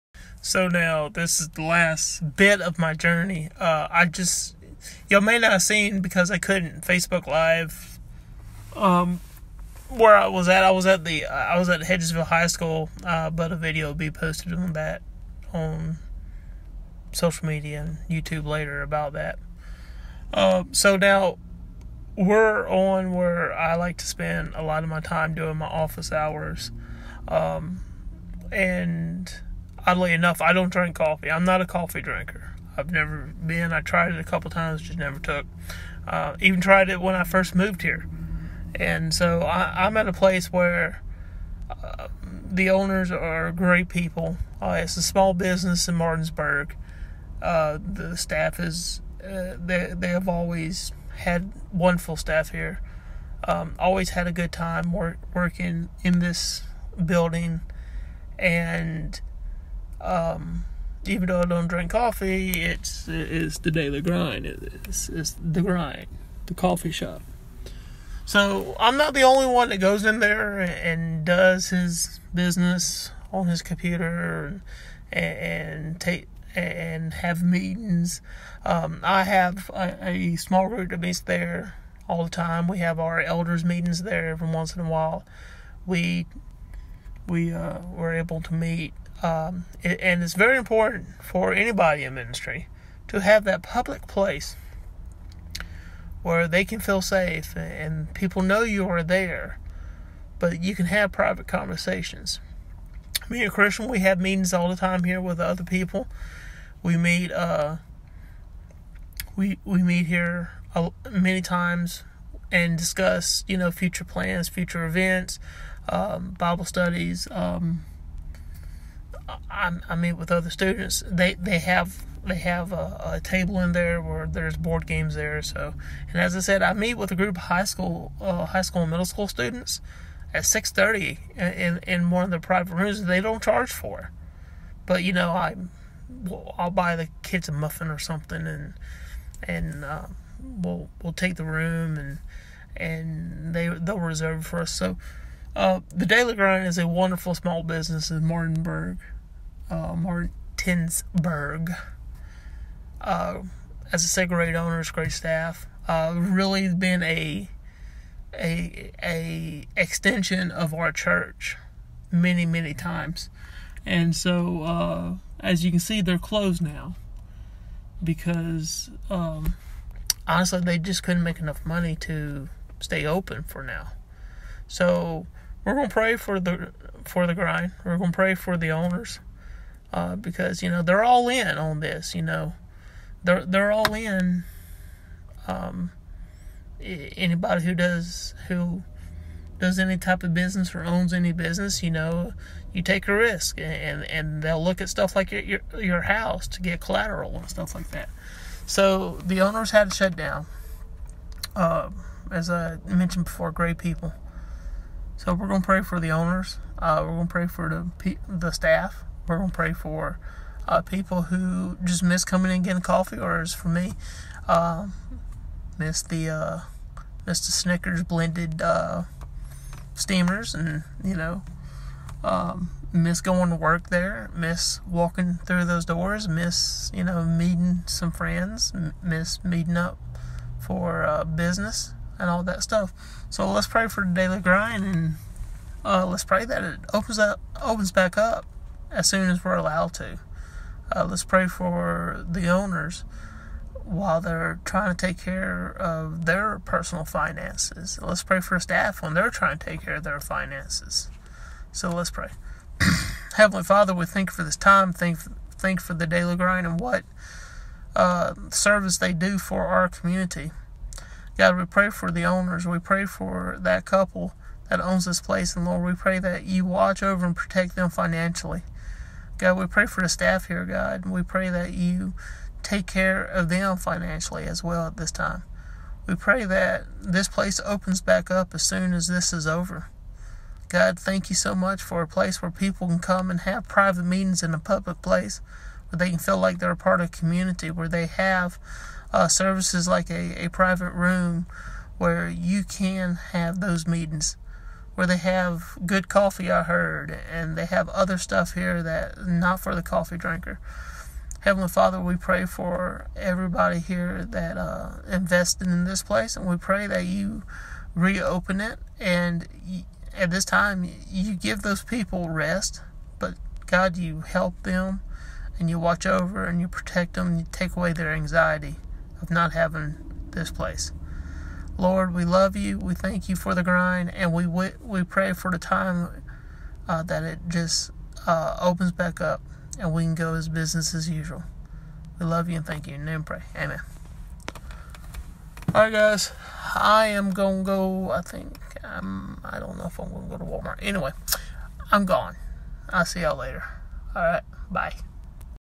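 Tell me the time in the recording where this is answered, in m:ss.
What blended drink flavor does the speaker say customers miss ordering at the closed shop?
3:37.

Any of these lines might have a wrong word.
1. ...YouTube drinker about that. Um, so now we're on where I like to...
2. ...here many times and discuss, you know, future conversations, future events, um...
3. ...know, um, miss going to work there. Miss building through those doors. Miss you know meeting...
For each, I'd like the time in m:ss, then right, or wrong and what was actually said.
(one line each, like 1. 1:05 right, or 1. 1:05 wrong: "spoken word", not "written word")
1. 0:18 wrong: "later", not "drinker"
2. 1:50 wrong: "plans", not "conversations"
3. 3:41 wrong: "walking", not "building".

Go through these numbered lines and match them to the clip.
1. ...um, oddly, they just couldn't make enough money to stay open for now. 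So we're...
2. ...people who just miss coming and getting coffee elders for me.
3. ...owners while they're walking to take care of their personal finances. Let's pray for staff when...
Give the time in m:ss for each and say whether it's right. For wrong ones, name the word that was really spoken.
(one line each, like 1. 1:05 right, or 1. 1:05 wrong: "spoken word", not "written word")
1. 2:49 wrong: "honestly", not "oddly"
2. 3:30 wrong: "orders", not "elders"
3. 4:02 wrong: "trying", not "walking".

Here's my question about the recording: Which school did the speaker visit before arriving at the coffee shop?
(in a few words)
Hedgesville High School.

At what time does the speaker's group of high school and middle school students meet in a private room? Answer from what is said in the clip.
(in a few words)
6:30.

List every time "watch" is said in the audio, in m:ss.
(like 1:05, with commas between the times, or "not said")
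4:26, 5:15.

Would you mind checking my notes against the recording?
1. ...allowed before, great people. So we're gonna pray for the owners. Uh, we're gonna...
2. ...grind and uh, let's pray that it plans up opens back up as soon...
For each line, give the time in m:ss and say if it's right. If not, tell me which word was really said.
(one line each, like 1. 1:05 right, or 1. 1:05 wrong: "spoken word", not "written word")
1. 3:22 wrong: "mentioned", not "allowed"
2. 3:54 wrong: "opens", not "plans".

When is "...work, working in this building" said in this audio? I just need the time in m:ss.
0:54.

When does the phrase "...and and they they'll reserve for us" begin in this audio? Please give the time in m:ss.
2:21.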